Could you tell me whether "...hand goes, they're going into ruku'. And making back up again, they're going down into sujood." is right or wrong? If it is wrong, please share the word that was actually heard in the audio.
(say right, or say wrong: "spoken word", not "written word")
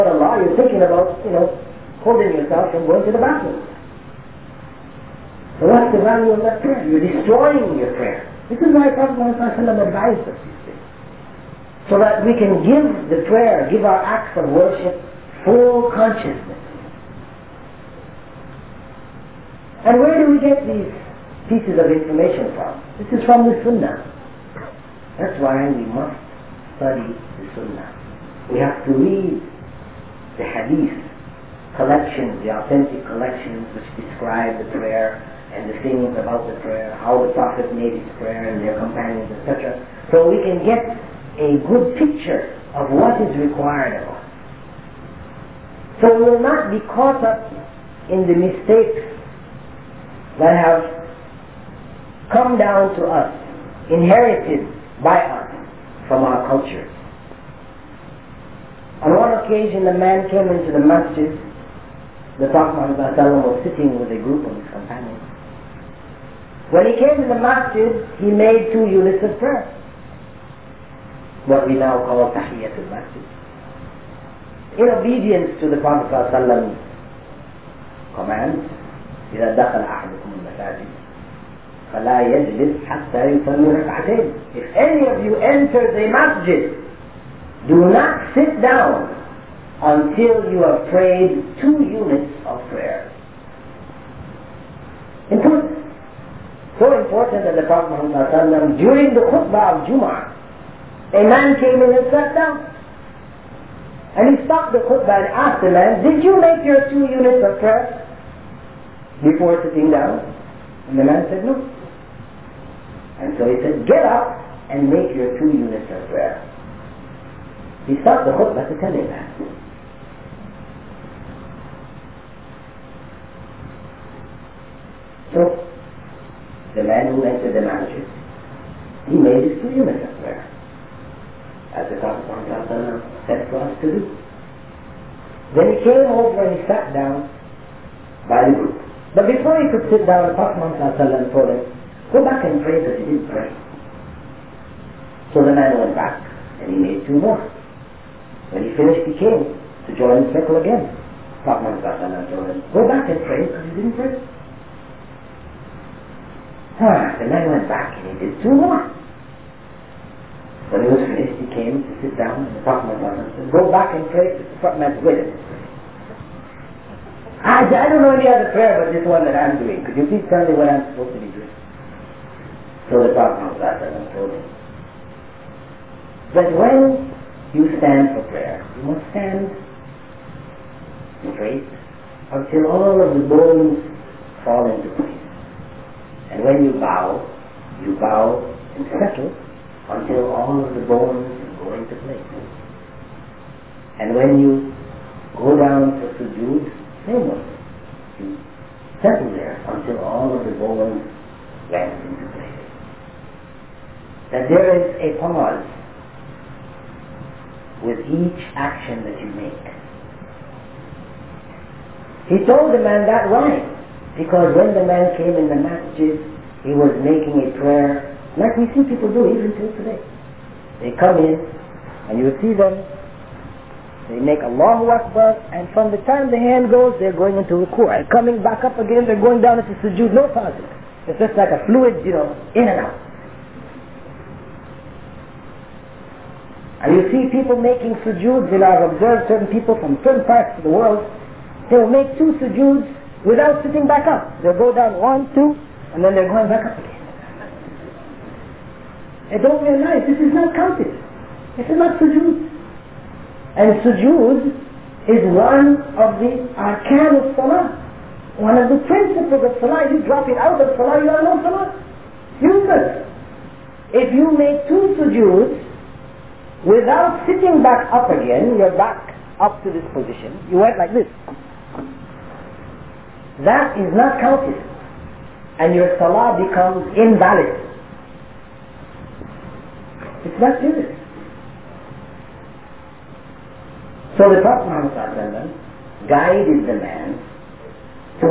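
wrong: "coming", not "making".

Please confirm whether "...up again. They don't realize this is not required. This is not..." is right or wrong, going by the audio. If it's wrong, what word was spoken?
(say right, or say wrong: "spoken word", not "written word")
wrong: "counted", not "required".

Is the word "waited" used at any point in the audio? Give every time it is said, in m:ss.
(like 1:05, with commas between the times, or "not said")
2:45.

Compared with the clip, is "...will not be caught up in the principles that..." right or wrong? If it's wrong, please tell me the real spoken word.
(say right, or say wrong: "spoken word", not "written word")
wrong: "mistakes", not "principles".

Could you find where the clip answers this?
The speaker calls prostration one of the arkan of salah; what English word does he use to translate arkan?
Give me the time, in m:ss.
4:18.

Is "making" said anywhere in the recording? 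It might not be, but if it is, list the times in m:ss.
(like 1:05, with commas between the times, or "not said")
3:37, 3:57.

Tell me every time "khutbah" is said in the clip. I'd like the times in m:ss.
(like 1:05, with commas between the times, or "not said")
1:39, 1:44, 1:58.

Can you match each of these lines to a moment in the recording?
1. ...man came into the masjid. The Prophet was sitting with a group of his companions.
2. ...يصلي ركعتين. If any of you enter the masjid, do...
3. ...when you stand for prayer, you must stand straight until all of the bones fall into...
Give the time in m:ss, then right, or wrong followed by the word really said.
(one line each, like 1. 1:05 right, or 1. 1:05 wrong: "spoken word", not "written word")
1. 0:59 right
2. 1:23 right
3. 2:56 right.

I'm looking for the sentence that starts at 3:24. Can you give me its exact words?
That there is a pause with each action that you make.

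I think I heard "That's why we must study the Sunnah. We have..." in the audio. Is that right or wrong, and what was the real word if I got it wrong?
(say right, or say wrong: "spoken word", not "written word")
right.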